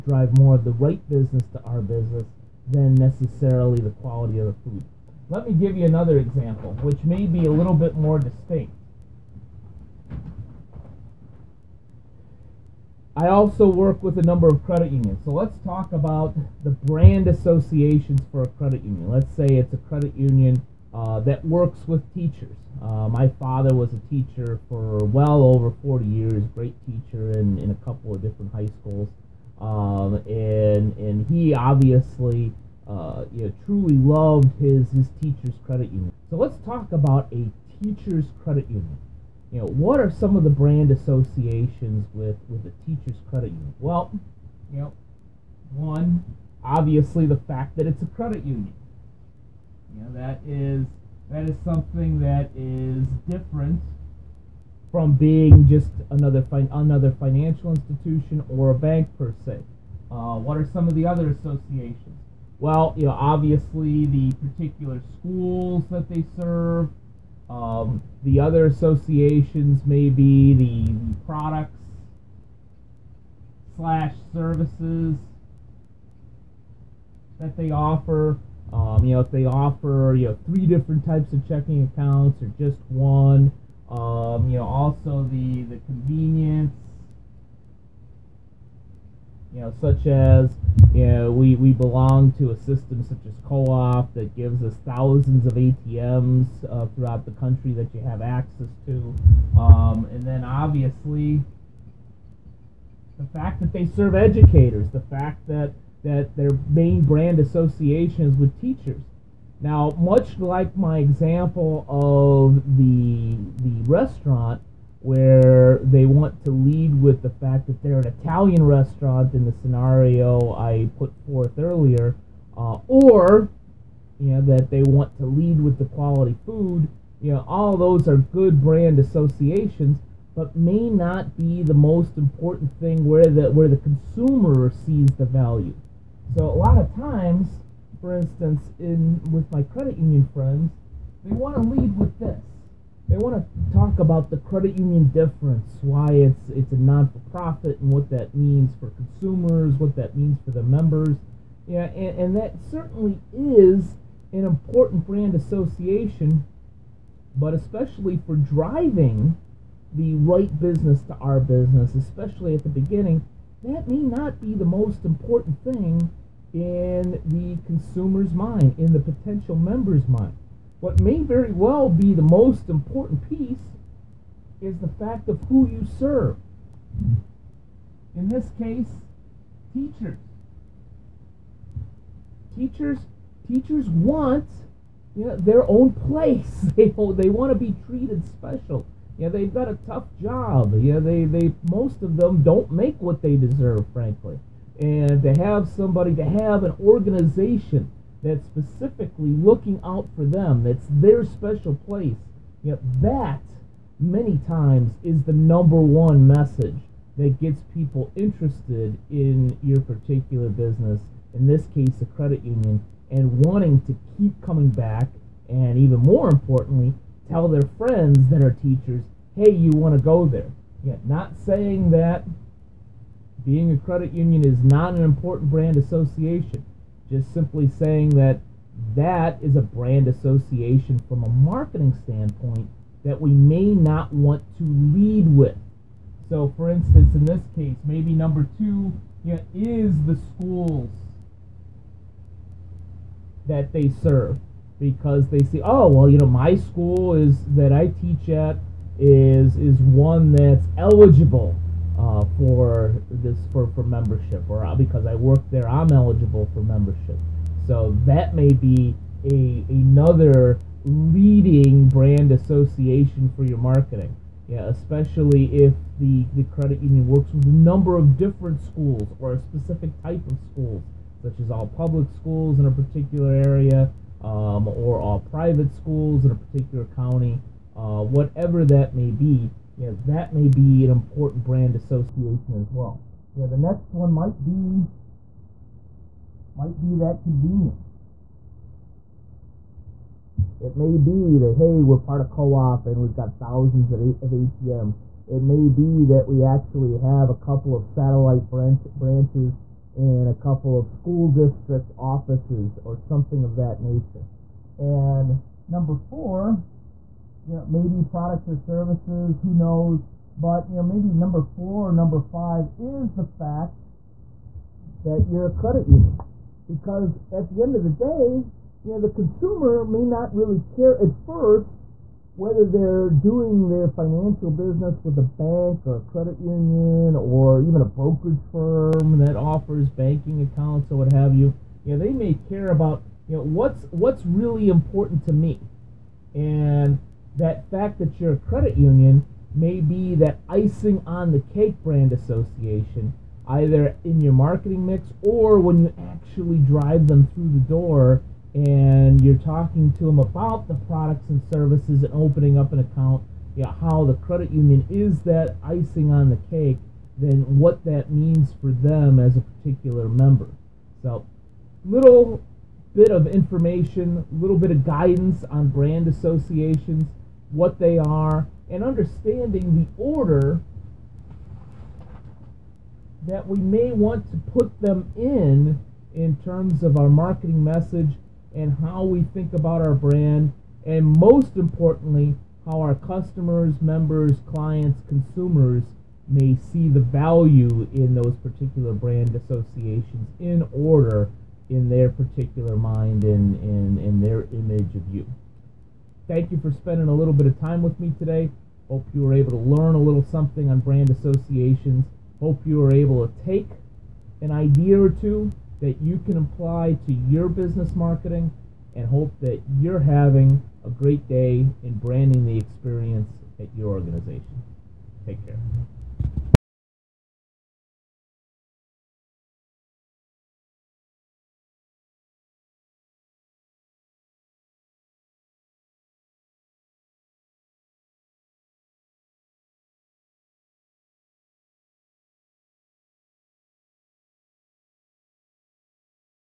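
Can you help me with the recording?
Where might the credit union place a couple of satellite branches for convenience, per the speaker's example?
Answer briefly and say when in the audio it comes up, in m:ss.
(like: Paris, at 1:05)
school district offices, at 5:00.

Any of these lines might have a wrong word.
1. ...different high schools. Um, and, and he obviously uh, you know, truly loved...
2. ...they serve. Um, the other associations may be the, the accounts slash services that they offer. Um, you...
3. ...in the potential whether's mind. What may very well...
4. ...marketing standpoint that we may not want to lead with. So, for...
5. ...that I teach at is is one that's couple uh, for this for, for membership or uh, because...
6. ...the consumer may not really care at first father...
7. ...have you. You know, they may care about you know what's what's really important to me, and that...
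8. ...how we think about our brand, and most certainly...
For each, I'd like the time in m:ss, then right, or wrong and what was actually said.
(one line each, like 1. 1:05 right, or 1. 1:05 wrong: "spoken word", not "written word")
1. 0:28 right
2. 1:06 wrong: "products", not "accounts"
3. 2:48 wrong: "member", not "whether"
4. 3:51 right
5. 4:07 wrong: "eligible", not "couple"
6. 5:18 wrong: "whether", not "father"
7. 5:31 right
8. 6:18 wrong: "importantly", not "certainly".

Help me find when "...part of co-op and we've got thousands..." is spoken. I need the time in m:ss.
4:51.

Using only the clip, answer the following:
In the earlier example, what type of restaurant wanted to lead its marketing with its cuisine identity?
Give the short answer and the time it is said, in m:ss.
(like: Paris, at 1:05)
Italian, at 1:58.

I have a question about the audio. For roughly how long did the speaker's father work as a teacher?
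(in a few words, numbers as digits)
over 40 years.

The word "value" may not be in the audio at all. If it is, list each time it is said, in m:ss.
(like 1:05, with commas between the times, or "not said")
2:15, 6:26.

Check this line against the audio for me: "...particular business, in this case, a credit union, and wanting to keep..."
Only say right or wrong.
right.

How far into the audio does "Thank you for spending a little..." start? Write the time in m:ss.
6:36.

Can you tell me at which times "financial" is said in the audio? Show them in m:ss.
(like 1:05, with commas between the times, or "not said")
0:57, 5:23.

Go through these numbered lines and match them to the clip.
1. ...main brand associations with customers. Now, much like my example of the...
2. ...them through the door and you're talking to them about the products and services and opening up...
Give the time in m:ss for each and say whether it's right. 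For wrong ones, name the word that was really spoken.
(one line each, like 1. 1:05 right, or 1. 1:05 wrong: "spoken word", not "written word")
1. 1:46 wrong: "teachers", not "customers"
2. 5:47 right.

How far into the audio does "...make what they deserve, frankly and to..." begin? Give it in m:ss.
3:12.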